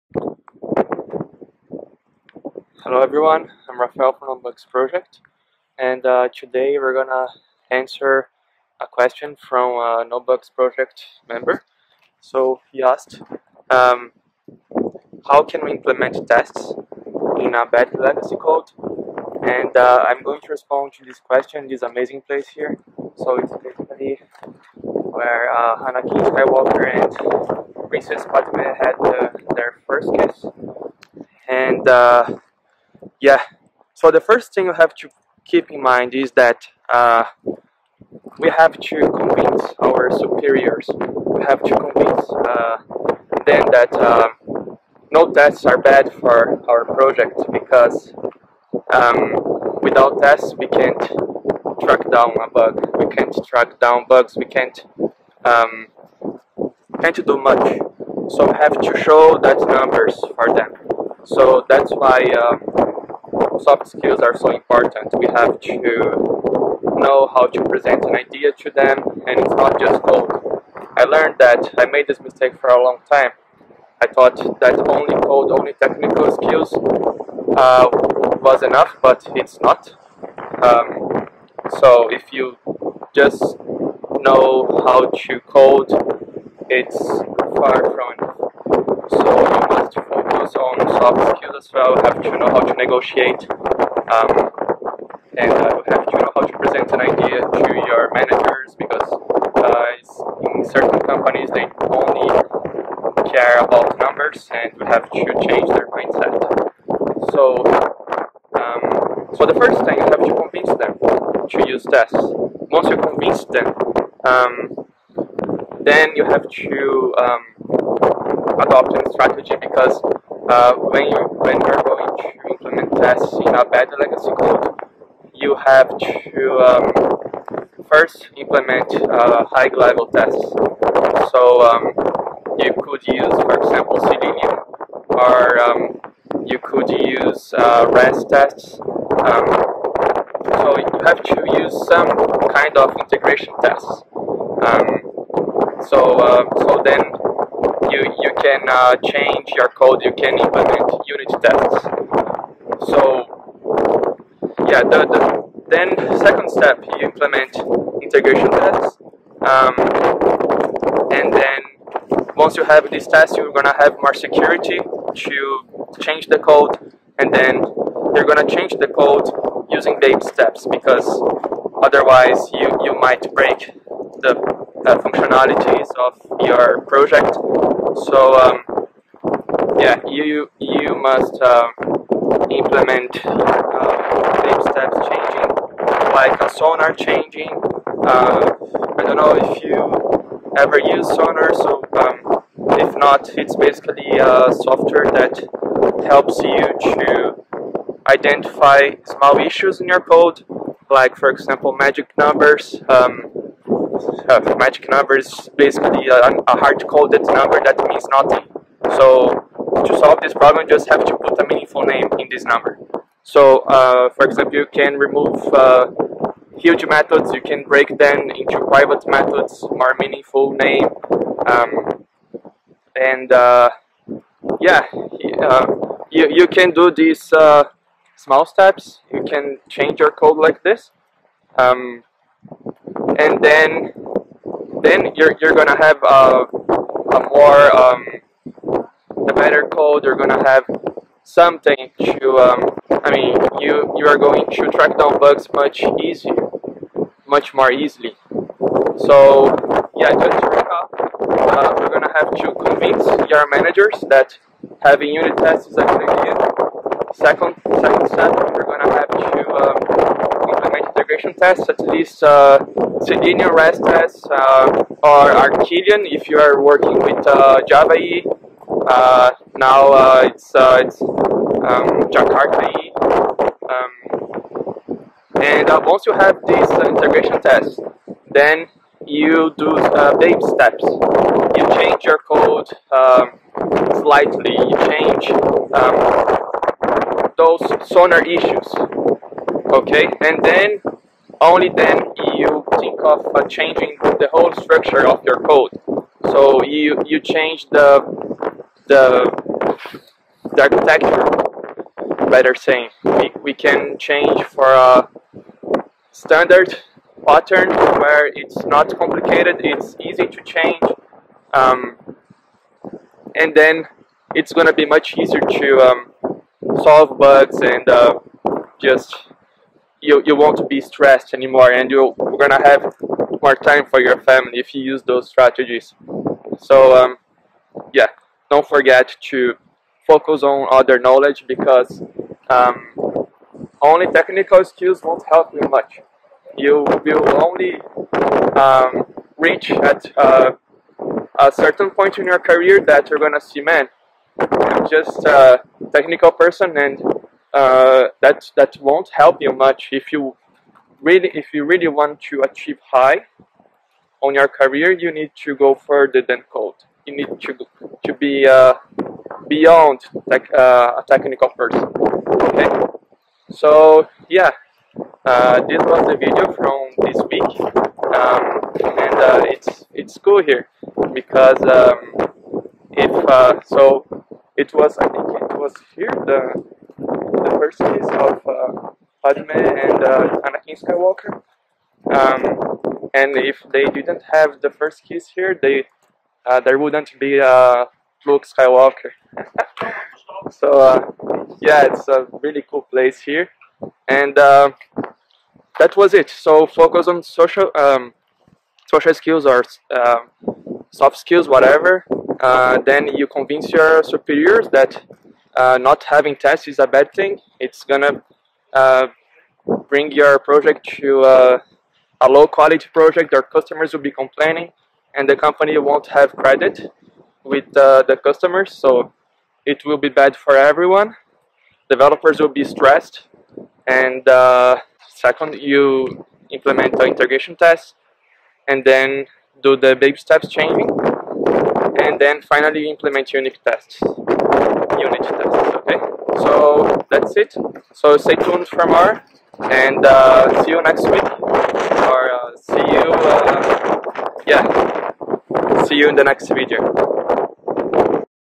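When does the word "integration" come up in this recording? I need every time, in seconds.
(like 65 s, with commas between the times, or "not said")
143 s, 158 s, 260 s, 276 s, 427 s.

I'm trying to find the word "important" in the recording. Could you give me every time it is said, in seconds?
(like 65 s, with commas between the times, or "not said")
64 s.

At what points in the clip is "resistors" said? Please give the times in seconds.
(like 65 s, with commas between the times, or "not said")
not said.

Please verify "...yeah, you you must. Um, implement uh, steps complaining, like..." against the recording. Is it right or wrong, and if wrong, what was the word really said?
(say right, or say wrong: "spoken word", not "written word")
wrong: "changing", not "complaining".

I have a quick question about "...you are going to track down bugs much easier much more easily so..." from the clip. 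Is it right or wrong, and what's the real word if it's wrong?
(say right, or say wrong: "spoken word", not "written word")
right.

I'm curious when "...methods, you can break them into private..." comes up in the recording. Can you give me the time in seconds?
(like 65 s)
216 s.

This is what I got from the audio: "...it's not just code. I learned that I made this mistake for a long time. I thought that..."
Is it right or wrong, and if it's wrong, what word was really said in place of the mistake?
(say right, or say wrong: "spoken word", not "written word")
right.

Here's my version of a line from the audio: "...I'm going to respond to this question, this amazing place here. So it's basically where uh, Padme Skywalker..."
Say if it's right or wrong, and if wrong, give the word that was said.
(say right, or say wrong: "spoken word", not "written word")
wrong: "Anakin", not "Padme".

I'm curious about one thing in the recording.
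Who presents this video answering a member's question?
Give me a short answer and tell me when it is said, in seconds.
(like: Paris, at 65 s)
Rafael, at 3 s.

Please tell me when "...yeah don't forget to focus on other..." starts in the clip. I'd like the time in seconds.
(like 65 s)
327 s.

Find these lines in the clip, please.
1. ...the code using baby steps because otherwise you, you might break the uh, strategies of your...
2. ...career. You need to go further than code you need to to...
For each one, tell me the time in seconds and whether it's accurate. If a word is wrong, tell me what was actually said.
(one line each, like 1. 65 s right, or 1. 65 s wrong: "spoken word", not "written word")
1. 168 s wrong: "functionalities", not "strategies"
2. 354 s right.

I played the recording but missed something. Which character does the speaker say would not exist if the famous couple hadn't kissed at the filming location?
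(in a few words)
Luke Skywalker.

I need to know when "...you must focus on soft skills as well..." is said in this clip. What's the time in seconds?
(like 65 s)
89 s.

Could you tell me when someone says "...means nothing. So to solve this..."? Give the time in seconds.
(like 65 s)
207 s.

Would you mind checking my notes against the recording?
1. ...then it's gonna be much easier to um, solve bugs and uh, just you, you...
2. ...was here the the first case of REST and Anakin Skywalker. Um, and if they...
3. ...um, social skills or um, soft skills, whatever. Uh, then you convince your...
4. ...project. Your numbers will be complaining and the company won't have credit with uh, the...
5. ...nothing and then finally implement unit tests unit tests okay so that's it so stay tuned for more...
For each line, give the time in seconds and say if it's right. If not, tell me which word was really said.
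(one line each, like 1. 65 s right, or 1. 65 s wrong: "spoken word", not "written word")
1. 313 s right
2. 375 s wrong: "Padme", not "REST"
3. 397 s right
4. 412 s wrong: "customers", not "numbers"
5. 430 s wrong: "changing", not "nothing".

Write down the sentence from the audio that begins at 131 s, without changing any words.
So um, you could use, for example, Selenium, or um, you could use uh, REST tests.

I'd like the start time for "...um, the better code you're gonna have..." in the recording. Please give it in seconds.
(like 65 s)
237 s.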